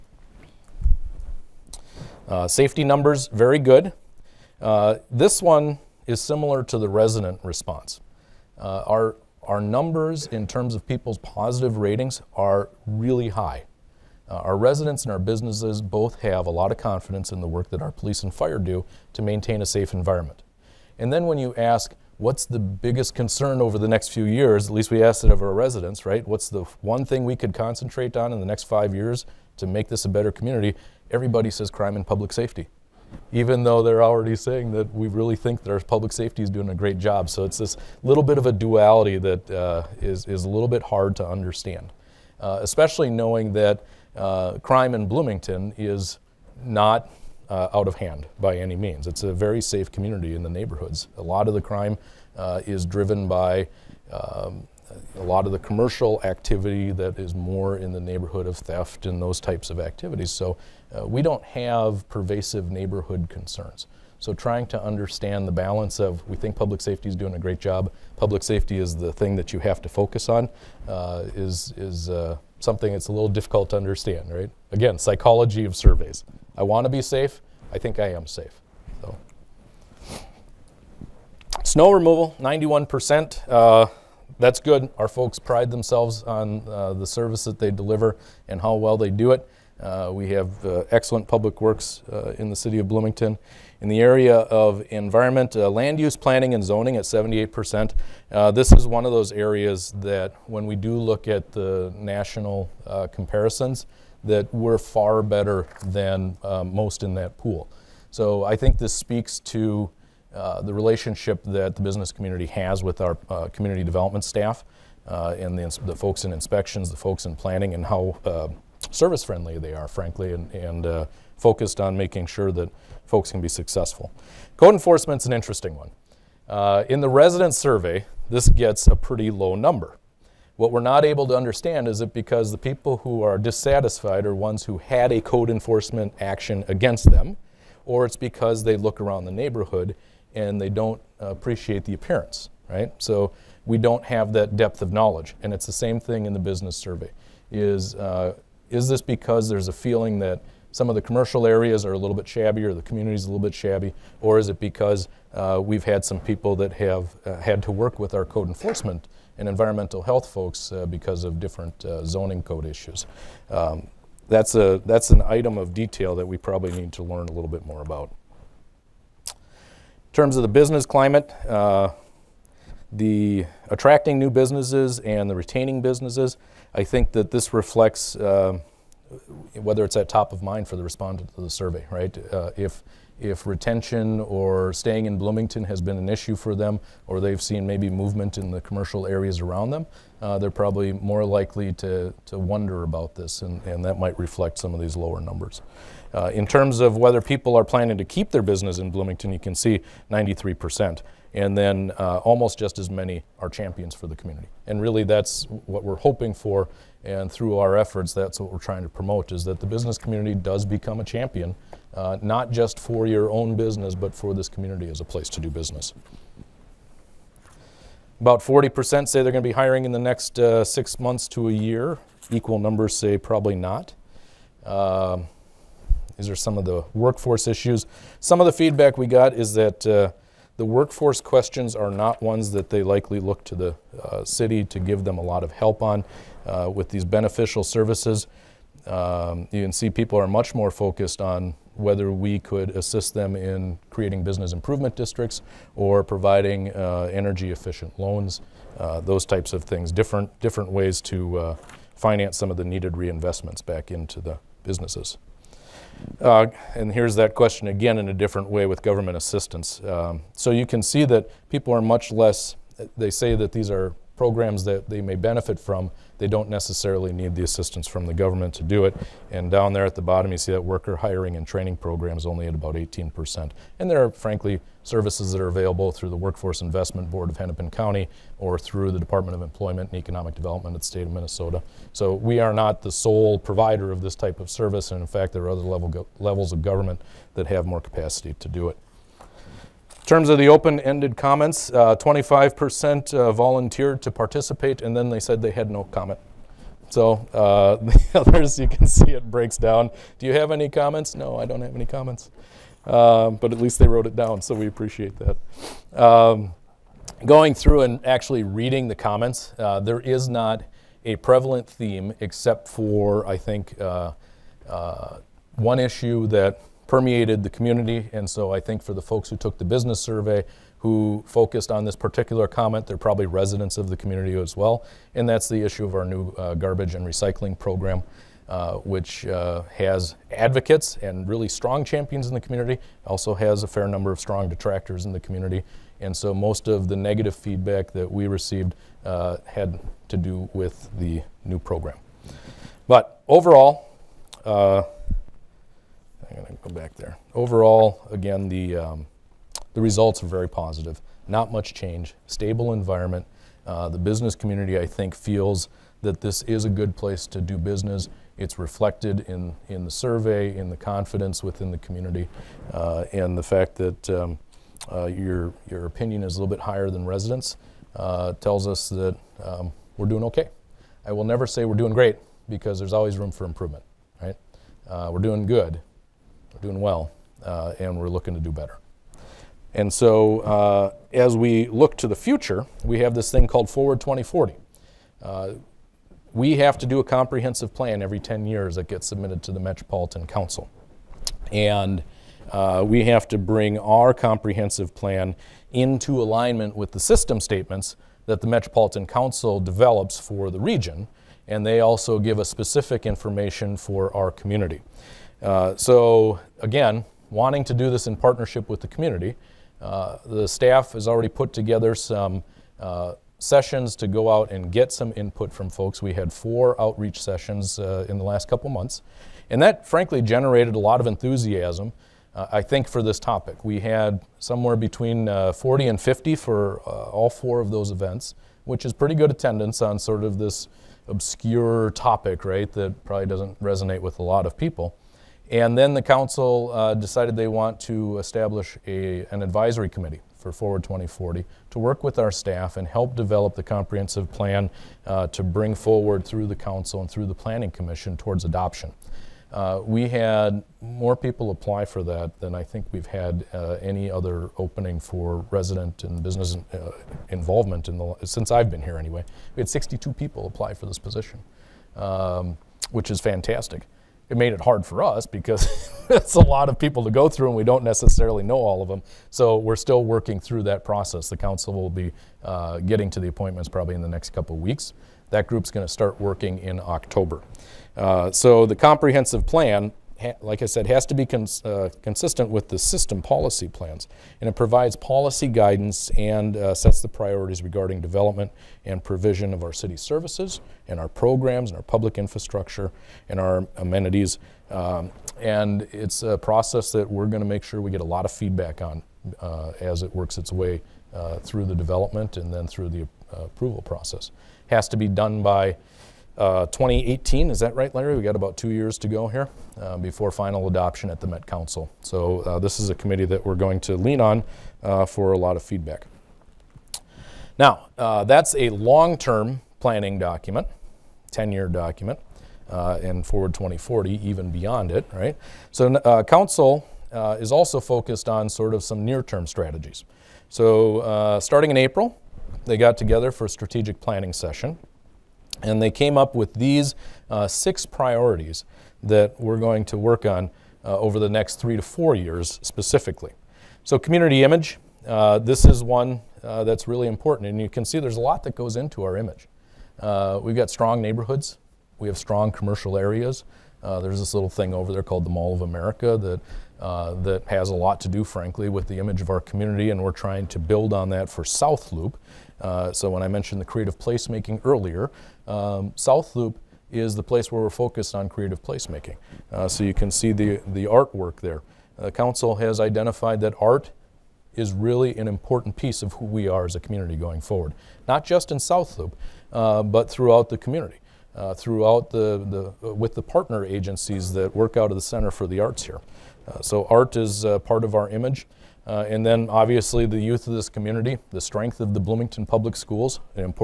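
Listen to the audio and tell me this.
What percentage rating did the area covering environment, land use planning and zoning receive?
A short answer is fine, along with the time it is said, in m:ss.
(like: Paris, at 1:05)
78%, at 1:37.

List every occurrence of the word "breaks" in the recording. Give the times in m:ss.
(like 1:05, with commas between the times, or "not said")
4:59.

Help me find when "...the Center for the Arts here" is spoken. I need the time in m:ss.
9:44.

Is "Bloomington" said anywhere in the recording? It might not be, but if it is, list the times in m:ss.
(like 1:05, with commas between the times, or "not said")
0:45, 1:32, 3:05, 3:18, 9:51.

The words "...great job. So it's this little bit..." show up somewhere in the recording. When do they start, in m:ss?
0:36.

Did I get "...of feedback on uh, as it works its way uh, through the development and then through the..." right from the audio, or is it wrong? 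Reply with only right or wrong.
right.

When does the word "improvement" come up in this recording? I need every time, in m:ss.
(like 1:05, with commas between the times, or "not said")
4:04, 6:13.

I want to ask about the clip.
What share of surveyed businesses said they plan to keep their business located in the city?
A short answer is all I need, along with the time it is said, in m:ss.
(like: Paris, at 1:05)
93%, at 3:20.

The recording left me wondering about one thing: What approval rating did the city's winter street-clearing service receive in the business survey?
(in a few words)
91%.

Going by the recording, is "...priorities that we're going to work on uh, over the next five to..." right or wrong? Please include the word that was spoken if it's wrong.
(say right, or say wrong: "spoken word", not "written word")
wrong: "three", not "five".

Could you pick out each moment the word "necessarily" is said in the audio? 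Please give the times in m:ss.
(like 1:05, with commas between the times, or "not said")
4:26, 7:47.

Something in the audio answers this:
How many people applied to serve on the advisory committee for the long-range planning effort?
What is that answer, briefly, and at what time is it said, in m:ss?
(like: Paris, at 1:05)
62, at 7:39.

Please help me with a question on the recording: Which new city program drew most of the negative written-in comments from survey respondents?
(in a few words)
garbage and recycling program.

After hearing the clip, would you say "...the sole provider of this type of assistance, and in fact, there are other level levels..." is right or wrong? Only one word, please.
wrong.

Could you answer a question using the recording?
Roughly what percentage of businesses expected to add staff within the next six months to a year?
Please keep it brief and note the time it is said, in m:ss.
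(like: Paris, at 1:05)
40%, at 3:38.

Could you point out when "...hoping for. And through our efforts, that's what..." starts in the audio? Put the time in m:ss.
3:25.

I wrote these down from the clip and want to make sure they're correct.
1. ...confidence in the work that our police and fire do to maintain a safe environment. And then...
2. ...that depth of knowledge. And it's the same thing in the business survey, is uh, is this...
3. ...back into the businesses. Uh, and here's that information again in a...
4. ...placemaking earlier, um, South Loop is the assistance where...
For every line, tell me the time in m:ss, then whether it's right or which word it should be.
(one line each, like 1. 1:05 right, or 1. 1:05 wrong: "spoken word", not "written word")
1. 0:16 right
2. 2:24 right
3. 4:13 wrong: "question", not "information"
4. 9:23 wrong: "place", not "assistance".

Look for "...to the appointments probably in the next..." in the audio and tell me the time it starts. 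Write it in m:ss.
7:53.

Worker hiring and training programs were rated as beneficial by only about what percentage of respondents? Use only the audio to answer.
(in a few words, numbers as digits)
18%.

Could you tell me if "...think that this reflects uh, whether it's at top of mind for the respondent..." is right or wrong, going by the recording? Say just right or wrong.
right.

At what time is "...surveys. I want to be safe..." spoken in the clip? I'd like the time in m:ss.
1:15.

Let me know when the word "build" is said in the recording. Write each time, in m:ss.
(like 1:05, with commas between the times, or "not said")
9:20.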